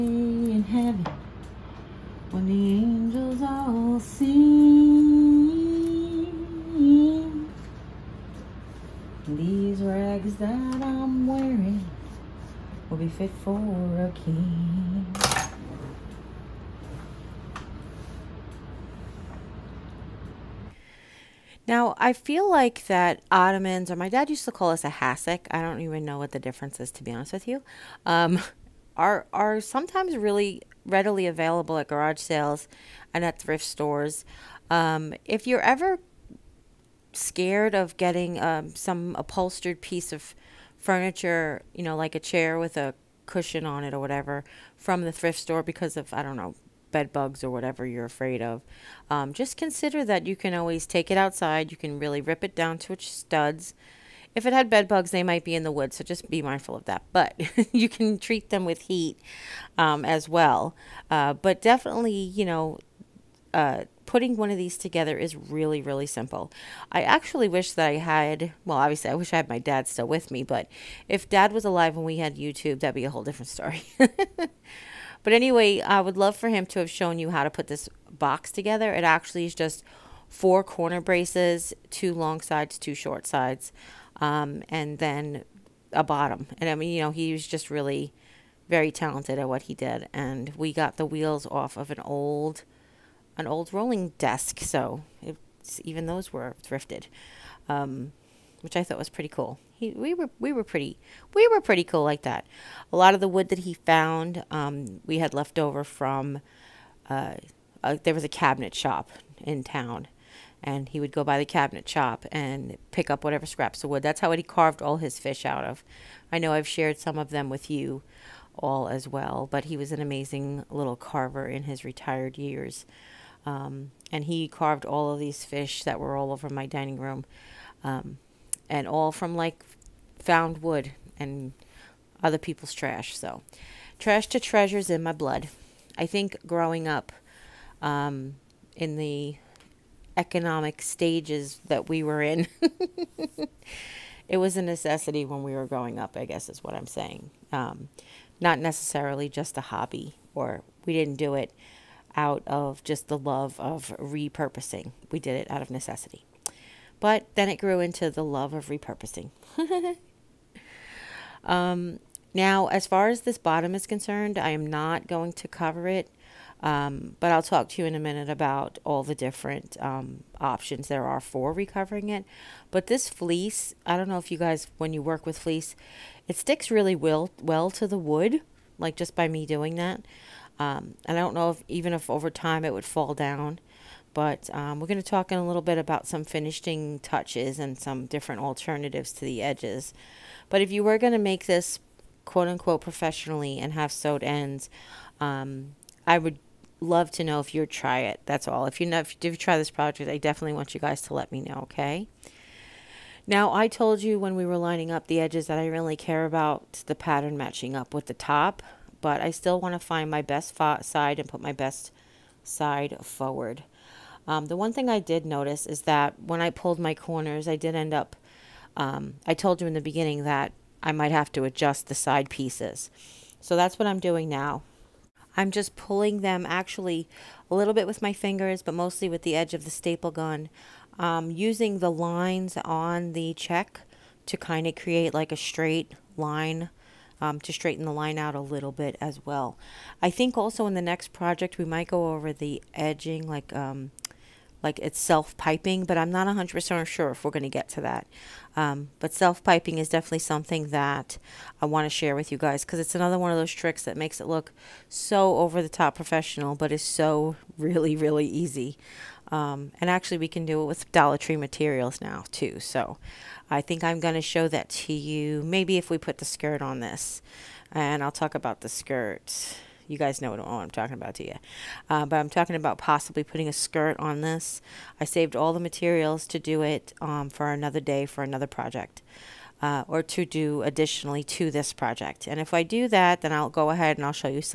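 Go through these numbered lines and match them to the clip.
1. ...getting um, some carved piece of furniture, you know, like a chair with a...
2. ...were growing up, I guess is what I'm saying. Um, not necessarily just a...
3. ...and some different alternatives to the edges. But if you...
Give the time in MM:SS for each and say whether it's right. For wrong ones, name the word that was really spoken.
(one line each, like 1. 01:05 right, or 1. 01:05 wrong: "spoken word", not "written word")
1. 00:37 wrong: "upholstered", not "carved"
2. 02:25 right
3. 03:07 right.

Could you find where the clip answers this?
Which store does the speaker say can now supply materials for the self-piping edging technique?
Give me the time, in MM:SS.
04:20.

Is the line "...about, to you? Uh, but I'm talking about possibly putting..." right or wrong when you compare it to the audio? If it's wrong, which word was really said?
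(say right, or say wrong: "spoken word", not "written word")
right.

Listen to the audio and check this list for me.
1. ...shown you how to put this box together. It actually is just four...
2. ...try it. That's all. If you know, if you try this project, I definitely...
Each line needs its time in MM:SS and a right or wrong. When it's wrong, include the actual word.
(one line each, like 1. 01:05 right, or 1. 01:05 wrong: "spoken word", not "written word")
1. 01:16 right
2. 03:17 right.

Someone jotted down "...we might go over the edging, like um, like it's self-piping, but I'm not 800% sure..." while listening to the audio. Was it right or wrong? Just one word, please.
wrong.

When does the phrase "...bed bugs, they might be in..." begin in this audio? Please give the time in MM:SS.
00:54.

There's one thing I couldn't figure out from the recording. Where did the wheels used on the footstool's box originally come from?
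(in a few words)
An old rolling desk.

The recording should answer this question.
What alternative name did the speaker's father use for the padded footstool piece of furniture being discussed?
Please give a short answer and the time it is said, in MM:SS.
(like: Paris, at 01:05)
Hassock, at 00:24.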